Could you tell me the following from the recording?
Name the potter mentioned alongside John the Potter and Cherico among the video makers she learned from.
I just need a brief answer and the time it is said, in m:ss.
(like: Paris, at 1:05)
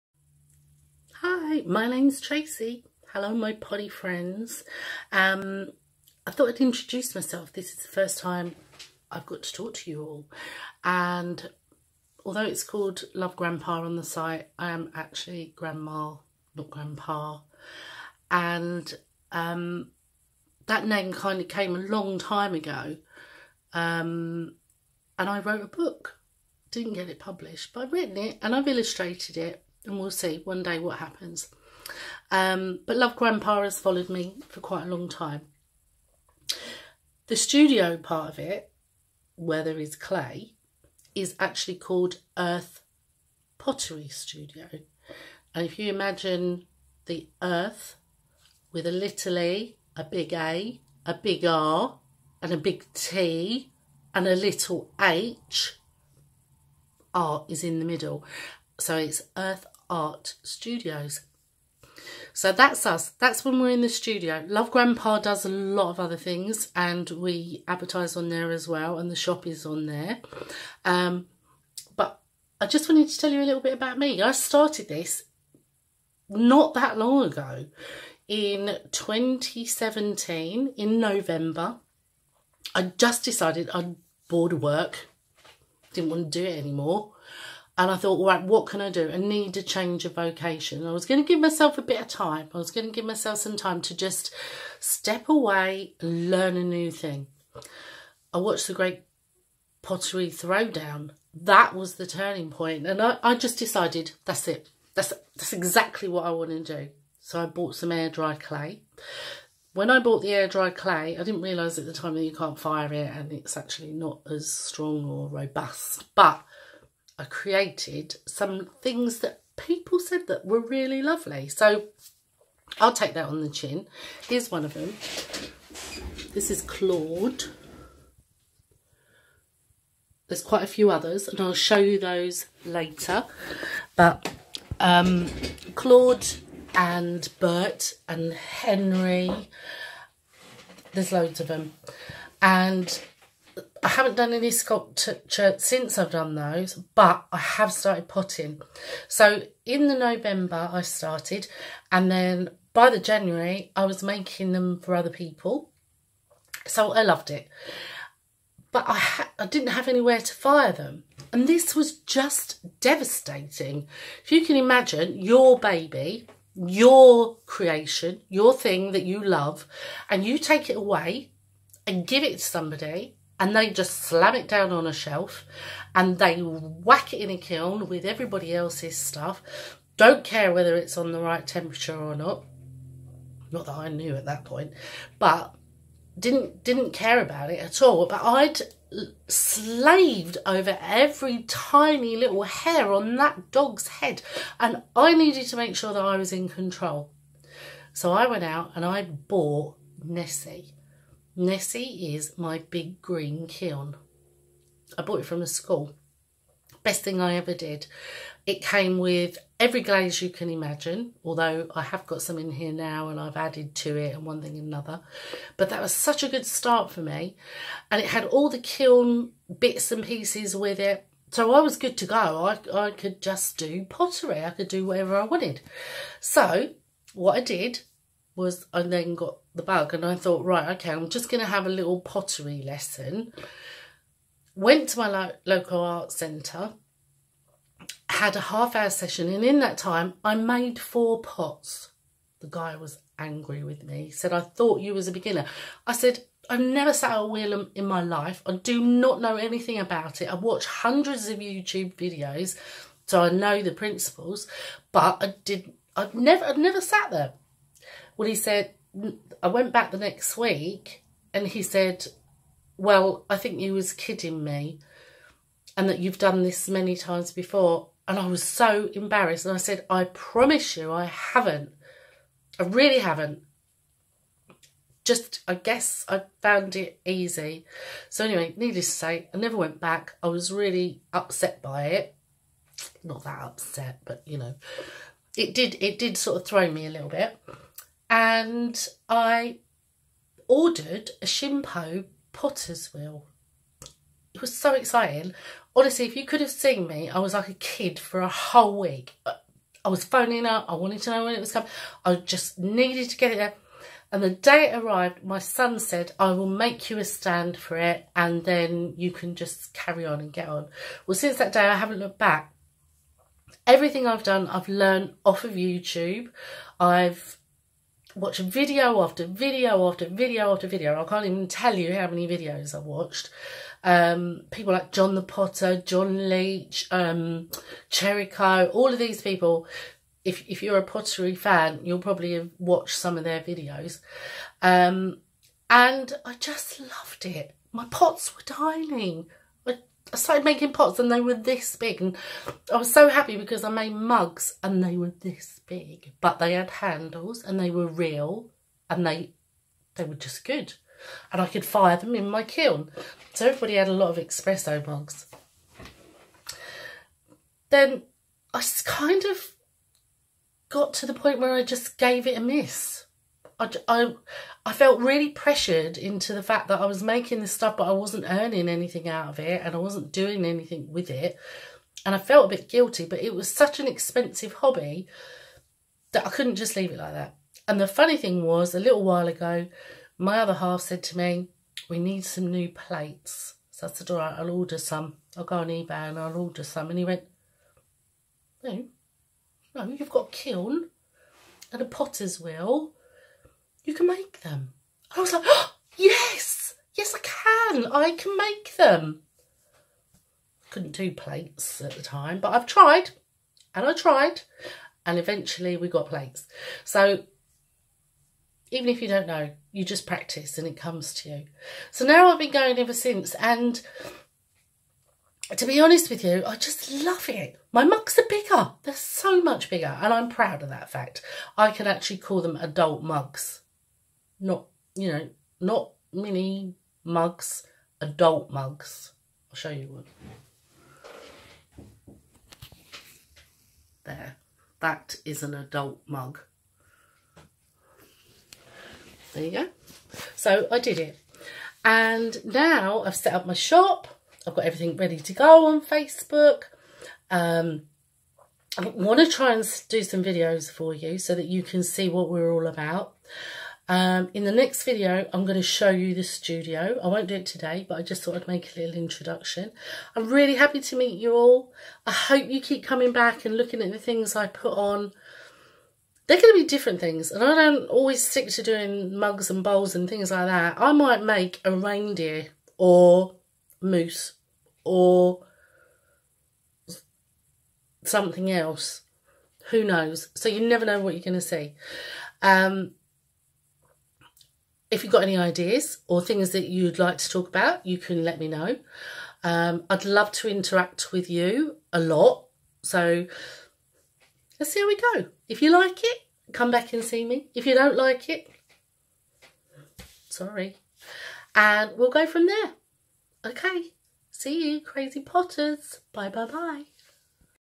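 John Leach, at 5:25.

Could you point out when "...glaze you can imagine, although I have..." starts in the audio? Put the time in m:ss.
3:29.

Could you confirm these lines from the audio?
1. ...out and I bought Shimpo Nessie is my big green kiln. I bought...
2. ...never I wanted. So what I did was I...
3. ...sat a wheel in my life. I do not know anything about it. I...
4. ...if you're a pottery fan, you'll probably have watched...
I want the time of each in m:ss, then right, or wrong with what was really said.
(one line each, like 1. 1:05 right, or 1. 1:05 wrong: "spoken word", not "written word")
1. 3:18 wrong: "Nessie", not "Shimpo"
2. 3:44 wrong: "whatever", not "never"
3. 4:06 right
4. 5:30 right.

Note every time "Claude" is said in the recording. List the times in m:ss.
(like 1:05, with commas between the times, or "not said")
2:06, 2:15.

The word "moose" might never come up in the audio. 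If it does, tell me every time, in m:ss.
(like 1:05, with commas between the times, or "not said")
7:53.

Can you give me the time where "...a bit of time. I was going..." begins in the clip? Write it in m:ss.
1:31.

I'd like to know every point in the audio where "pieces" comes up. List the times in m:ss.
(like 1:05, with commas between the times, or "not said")
3:40.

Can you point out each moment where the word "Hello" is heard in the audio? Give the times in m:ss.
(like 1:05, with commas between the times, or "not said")
0:03.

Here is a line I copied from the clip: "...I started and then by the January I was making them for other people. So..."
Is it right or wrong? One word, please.
right.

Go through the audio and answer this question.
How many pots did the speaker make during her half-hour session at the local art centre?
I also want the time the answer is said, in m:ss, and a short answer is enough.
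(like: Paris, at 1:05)
4, at 4:00.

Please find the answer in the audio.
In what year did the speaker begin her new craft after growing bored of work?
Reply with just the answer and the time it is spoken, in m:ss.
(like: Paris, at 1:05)
2017, at 1:18.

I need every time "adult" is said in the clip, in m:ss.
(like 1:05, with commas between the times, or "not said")
7:02, 7:08, 7:15.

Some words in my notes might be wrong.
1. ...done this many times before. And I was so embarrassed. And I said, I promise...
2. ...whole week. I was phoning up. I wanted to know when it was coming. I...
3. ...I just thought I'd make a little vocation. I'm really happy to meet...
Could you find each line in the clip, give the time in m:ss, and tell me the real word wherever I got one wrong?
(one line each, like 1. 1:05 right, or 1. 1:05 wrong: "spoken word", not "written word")
1. 4:26 right
2. 4:58 right
3. 7:37 wrong: "introduction", not "vocation".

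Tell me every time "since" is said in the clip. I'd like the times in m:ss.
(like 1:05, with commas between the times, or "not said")
2:25, 5:11, 6:52.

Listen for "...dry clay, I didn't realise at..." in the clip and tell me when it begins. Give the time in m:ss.
1:50.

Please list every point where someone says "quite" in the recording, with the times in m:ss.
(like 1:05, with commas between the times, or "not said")
0:34, 2:10.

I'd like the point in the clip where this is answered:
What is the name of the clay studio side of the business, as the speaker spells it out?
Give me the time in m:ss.
0:42.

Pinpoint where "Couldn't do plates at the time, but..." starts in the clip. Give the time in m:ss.
6:40.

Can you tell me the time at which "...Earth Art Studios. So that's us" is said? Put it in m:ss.
0:59.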